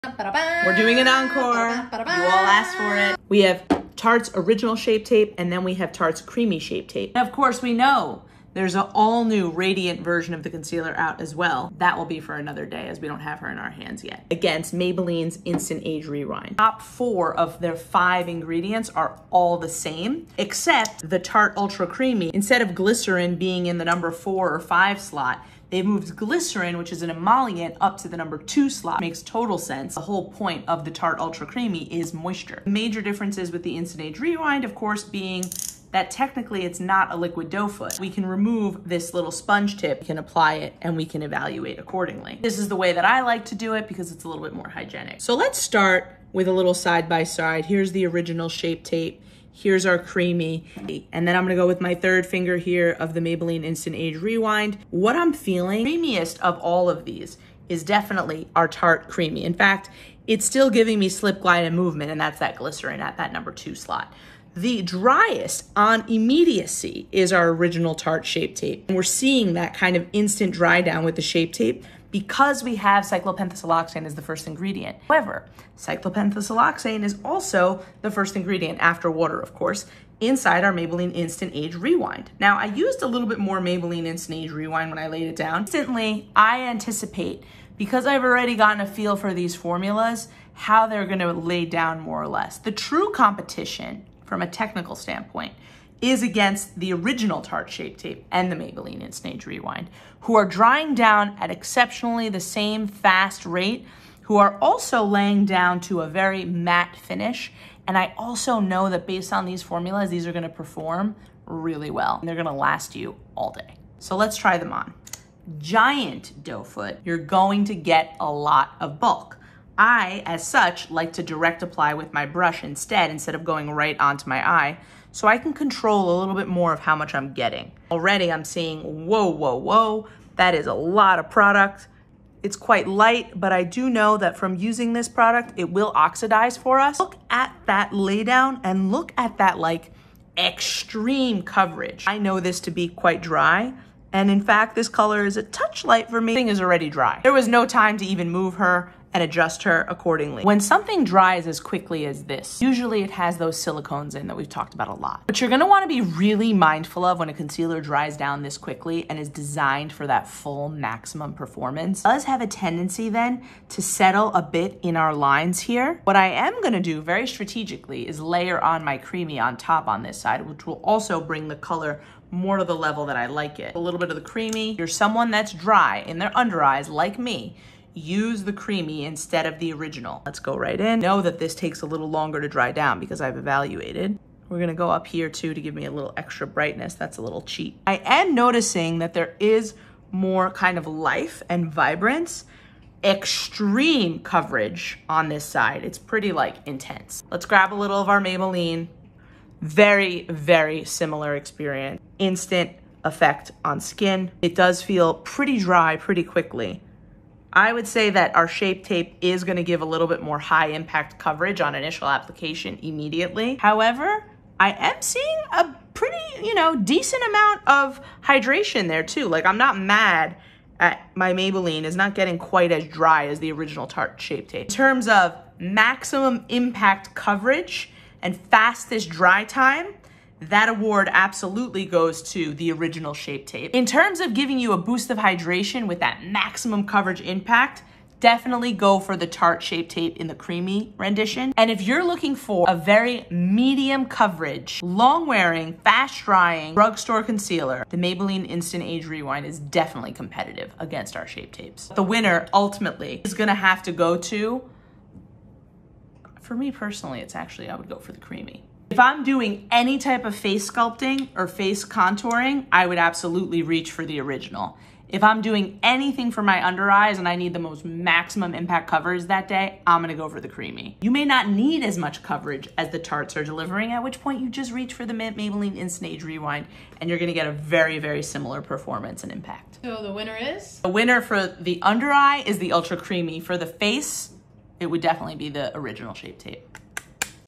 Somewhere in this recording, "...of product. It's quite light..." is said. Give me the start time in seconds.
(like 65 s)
131 s.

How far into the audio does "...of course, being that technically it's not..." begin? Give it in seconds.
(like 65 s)
34 s.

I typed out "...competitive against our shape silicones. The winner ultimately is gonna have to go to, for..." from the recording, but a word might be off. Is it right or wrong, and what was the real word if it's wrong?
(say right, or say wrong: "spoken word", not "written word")
wrong: "tapes", not "silicones".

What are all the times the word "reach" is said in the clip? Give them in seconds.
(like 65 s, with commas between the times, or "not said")
263 s, 274 s.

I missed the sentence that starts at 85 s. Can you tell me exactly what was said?
Instantly, I anticipate, because I've already gotten a feel for these formulas, how they're gonna lay down more or less.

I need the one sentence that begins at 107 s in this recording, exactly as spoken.
And I also know that based on these formulas, these are gonna perform really well.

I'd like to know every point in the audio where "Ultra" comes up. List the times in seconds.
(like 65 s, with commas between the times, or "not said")
21 s, 31 s, 282 s.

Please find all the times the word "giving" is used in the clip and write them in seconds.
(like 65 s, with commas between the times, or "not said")
60 s, 234 s.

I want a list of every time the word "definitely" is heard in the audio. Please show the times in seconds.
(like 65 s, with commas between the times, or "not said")
57 s, 238 s, 249 s, 285 s.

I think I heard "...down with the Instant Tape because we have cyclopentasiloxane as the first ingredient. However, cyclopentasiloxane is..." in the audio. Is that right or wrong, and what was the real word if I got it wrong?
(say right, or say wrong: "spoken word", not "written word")
wrong: "Shape", not "Instant".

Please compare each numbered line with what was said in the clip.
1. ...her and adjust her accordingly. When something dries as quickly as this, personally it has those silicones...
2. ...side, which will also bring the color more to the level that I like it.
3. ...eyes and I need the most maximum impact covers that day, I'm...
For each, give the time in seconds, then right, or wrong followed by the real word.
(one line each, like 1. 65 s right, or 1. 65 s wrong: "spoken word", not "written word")
1. 148 s wrong: "usually", not "personally"
2. 170 s right
3. 266 s right.